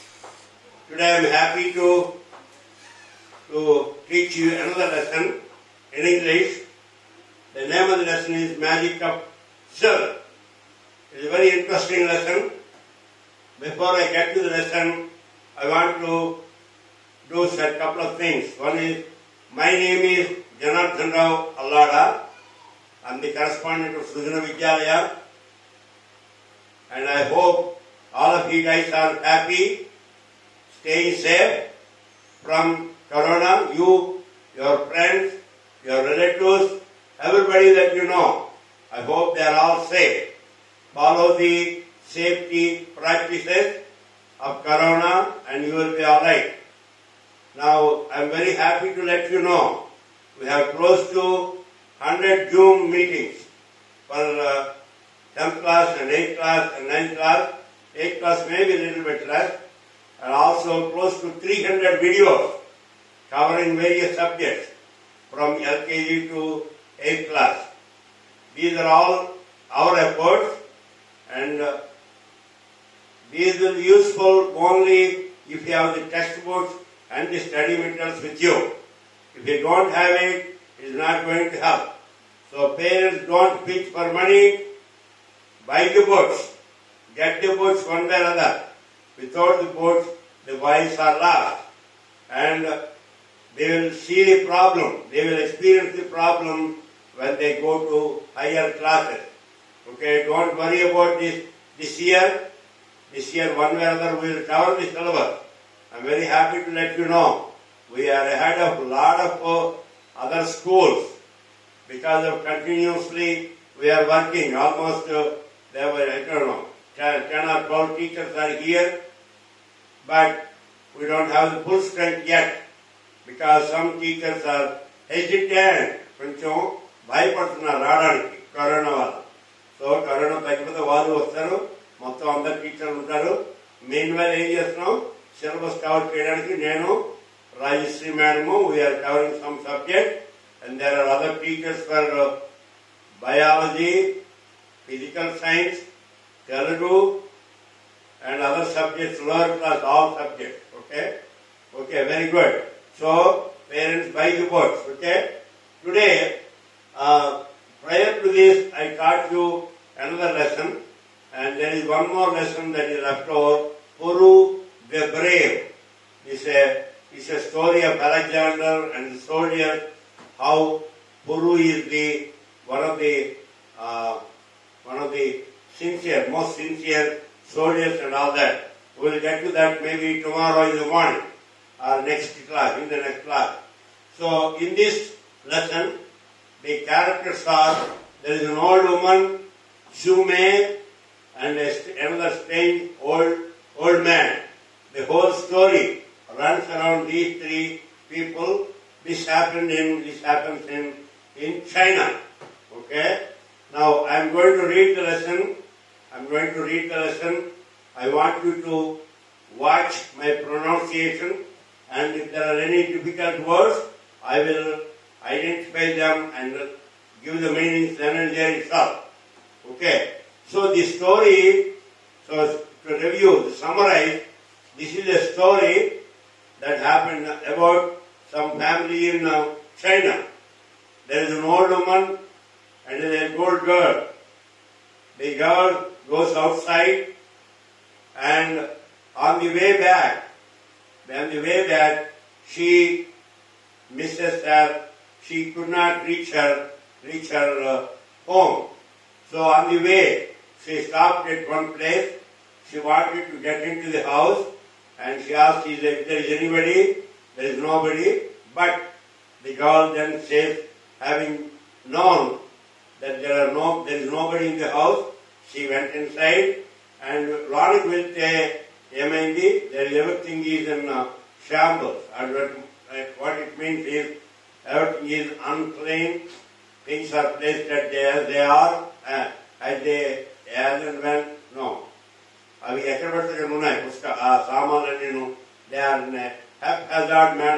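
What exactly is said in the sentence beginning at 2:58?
We will get to that maybe tomorrow in the morning or next class, in the next class.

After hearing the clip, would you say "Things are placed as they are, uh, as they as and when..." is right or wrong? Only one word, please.
right.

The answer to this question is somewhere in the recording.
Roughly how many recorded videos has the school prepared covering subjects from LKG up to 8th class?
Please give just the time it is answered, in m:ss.
1:01.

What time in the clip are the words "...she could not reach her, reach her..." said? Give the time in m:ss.
4:05.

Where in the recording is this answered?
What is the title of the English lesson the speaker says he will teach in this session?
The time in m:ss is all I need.
0:08.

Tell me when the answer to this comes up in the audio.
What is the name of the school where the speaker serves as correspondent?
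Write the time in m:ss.
0:24.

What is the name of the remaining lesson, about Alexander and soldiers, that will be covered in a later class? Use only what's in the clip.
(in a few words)
Puru the Brave.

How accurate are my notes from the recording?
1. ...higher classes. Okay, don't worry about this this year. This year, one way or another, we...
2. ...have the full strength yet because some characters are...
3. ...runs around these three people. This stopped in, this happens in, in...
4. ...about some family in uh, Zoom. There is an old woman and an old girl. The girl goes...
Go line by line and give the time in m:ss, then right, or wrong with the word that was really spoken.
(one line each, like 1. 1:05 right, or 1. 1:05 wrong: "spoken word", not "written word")
1. 1:38 right
2. 2:01 wrong: "teachers", not "characters"
3. 3:16 wrong: "happened", not "stopped"
4. 3:47 wrong: "China", not "Zoom".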